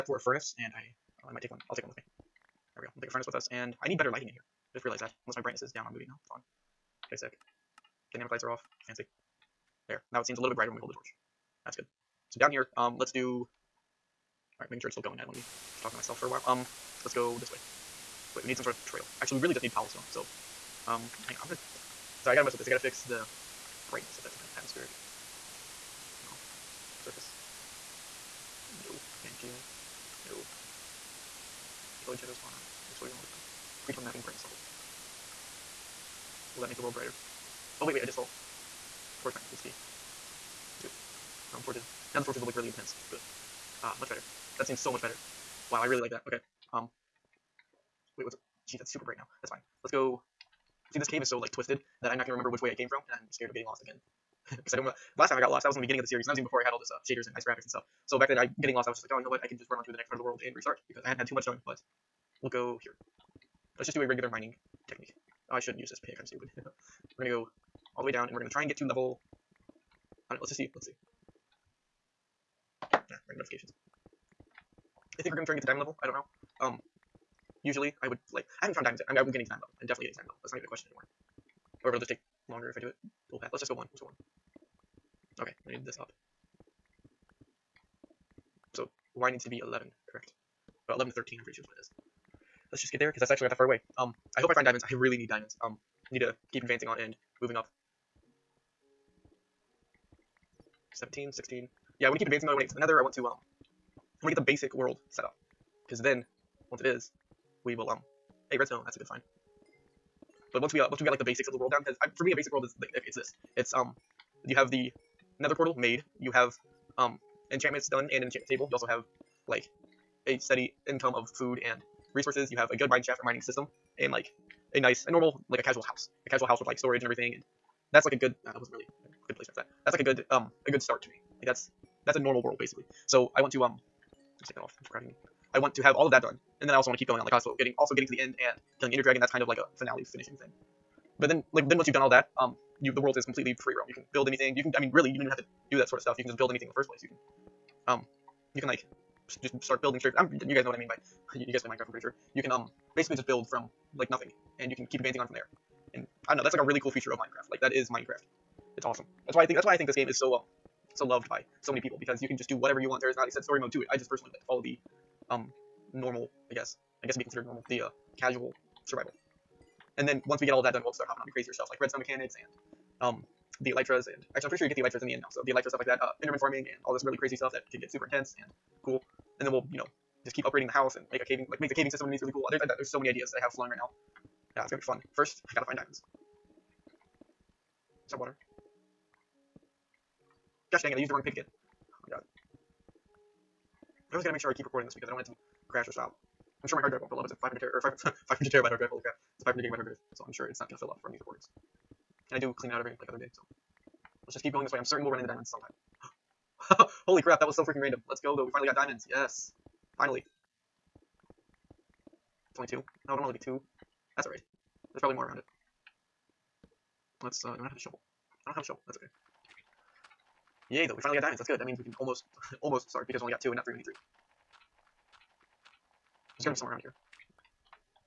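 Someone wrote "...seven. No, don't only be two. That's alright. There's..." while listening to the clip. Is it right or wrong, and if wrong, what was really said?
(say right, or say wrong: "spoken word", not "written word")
wrong: "two", not "seven".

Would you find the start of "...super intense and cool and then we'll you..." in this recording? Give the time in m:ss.
2:57.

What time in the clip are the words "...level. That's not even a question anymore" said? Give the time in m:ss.
1:20.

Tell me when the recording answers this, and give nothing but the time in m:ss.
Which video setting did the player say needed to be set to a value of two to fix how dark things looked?
0:39.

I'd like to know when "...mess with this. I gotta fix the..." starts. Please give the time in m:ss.
0:22.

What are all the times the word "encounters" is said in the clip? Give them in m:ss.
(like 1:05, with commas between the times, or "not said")
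not said.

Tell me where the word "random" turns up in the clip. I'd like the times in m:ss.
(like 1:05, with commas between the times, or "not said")
1:13, 3:27.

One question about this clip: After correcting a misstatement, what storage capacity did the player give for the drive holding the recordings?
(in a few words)
500 gigabyte.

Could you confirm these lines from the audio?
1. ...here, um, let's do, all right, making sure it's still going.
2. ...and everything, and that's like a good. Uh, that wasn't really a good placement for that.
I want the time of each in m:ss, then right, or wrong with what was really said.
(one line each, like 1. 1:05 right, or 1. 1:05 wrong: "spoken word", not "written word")
1. 0:12 right
2. 2:07 right.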